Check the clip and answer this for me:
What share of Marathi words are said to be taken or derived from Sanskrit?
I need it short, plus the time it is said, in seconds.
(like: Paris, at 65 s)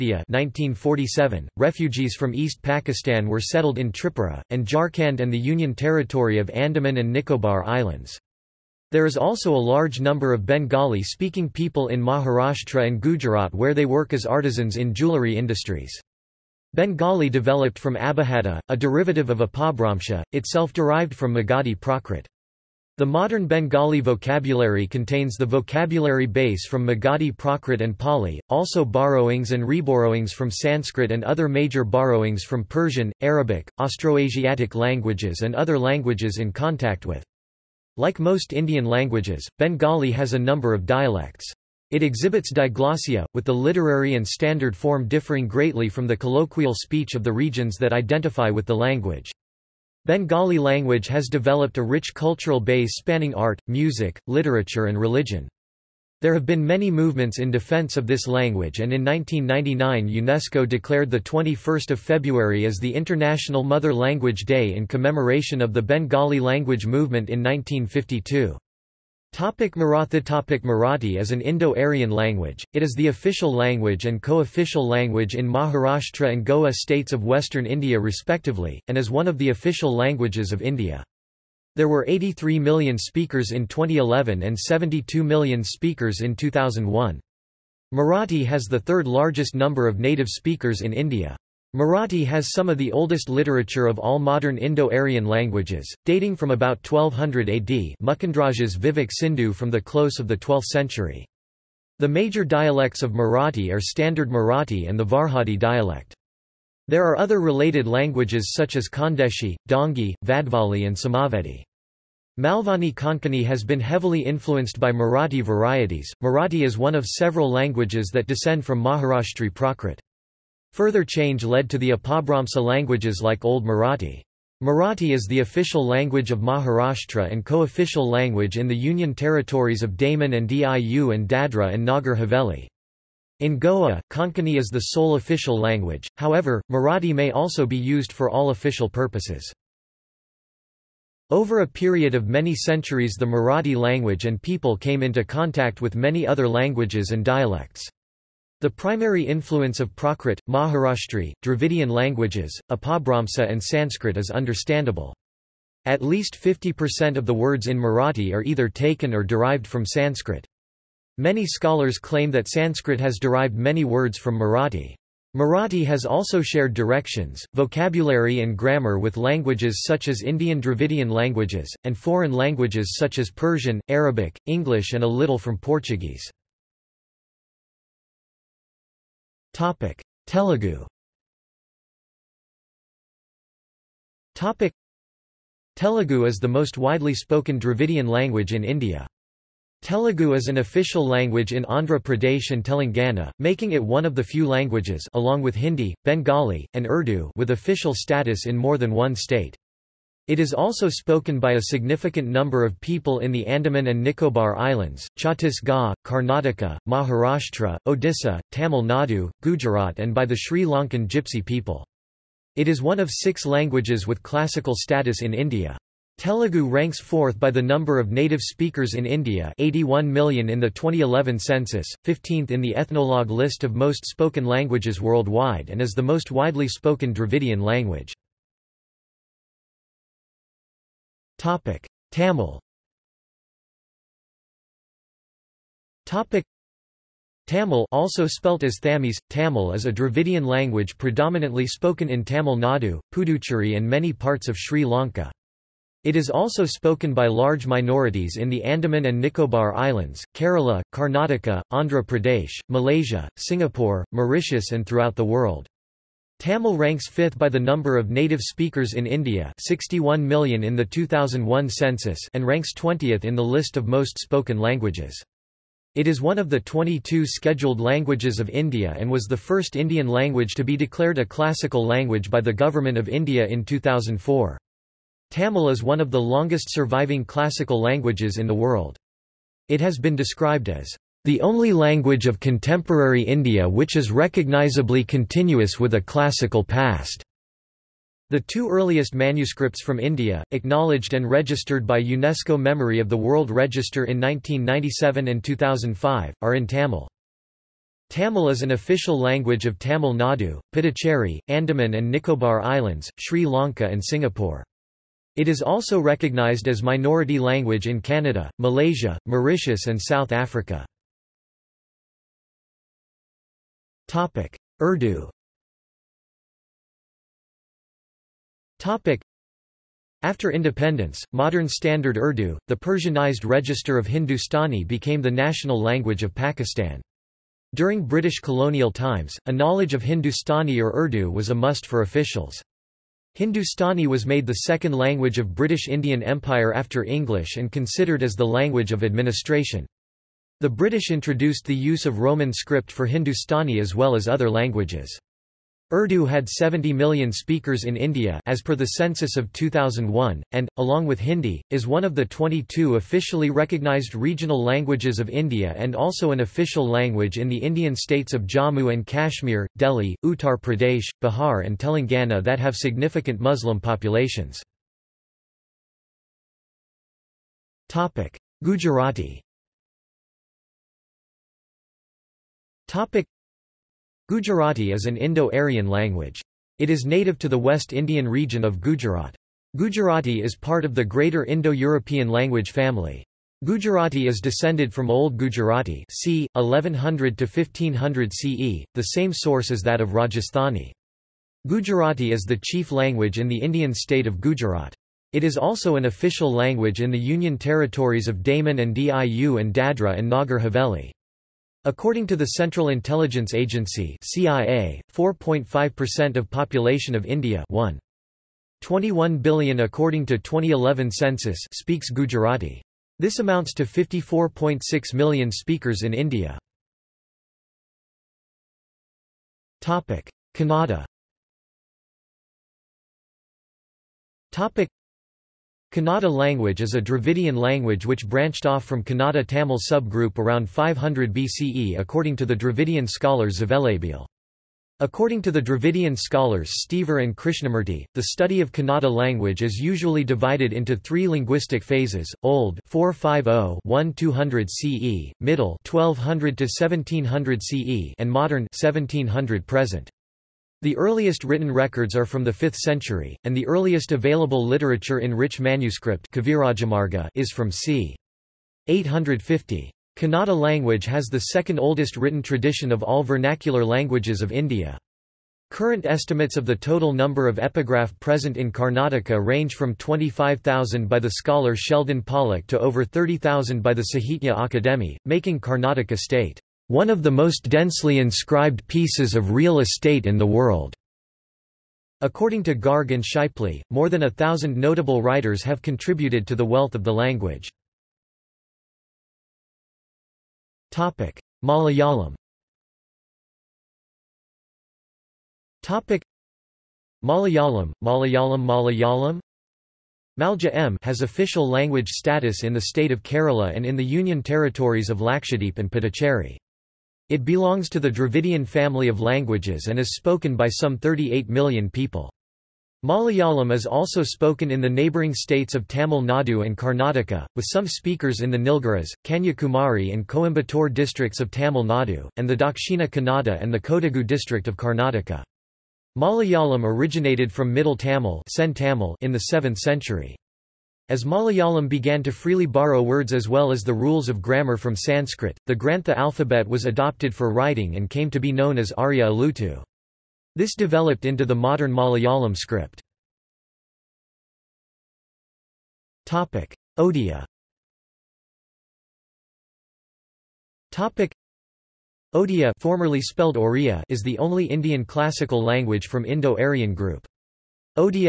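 At least 50%, at 155 s.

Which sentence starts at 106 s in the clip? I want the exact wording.
There are other related languages such as Khandeshi, Dongi, Vadvali and Samavedi.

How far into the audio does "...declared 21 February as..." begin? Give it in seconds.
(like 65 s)
60 s.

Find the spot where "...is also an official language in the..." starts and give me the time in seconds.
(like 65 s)
395 s.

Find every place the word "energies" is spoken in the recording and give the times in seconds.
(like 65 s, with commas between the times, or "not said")
not said.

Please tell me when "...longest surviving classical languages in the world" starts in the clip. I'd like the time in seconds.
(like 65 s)
276 s.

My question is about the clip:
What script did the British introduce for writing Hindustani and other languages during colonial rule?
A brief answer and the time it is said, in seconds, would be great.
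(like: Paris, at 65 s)
Roman script, at 342 s.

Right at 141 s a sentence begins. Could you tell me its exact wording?
Over a period of many centuries the Marathi language and people came into contact with many other languages and dialects.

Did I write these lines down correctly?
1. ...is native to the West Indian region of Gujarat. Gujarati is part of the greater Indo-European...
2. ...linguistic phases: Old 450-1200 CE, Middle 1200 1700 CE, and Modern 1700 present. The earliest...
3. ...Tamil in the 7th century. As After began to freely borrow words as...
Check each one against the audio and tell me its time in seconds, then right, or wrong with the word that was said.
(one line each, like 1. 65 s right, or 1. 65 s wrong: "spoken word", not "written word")
1. 376 s right
2. 441 s right
3. 527 s wrong: "Malayalam", not "After".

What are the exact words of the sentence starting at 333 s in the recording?
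Hindustani was made the second language of British Indian Empire after English and considered as the language of administration.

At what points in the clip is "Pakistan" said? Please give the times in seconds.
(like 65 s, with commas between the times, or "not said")
2 s, 326 s.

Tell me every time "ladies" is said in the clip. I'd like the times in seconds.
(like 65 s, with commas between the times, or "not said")
not said.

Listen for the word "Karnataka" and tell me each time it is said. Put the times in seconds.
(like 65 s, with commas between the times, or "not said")
206 s, 250 s, 468 s, 475 s, 516 s, 524 s.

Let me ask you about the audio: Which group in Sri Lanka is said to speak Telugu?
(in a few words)
Sri Lankan Gypsy people.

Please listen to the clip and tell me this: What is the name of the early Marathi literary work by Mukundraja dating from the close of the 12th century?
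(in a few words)
Vivek Sindhu.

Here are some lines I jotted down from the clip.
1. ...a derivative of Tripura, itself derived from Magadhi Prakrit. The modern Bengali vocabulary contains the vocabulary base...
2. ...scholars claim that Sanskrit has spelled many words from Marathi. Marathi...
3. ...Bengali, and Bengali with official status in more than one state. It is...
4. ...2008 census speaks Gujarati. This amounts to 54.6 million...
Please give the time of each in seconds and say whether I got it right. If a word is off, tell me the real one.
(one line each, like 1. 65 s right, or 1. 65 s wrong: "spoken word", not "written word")
1. 18 s wrong: "Apabhramsha", not "Tripura"
2. 161 s wrong: "derived", not "spelled"
3. 196 s wrong: "Urdu", not "Bengali"
4. 410 s wrong: "2011", not "2008".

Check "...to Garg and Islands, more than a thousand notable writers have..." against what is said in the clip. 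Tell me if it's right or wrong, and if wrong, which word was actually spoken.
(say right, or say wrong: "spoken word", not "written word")
wrong: "Shipley", not "Islands".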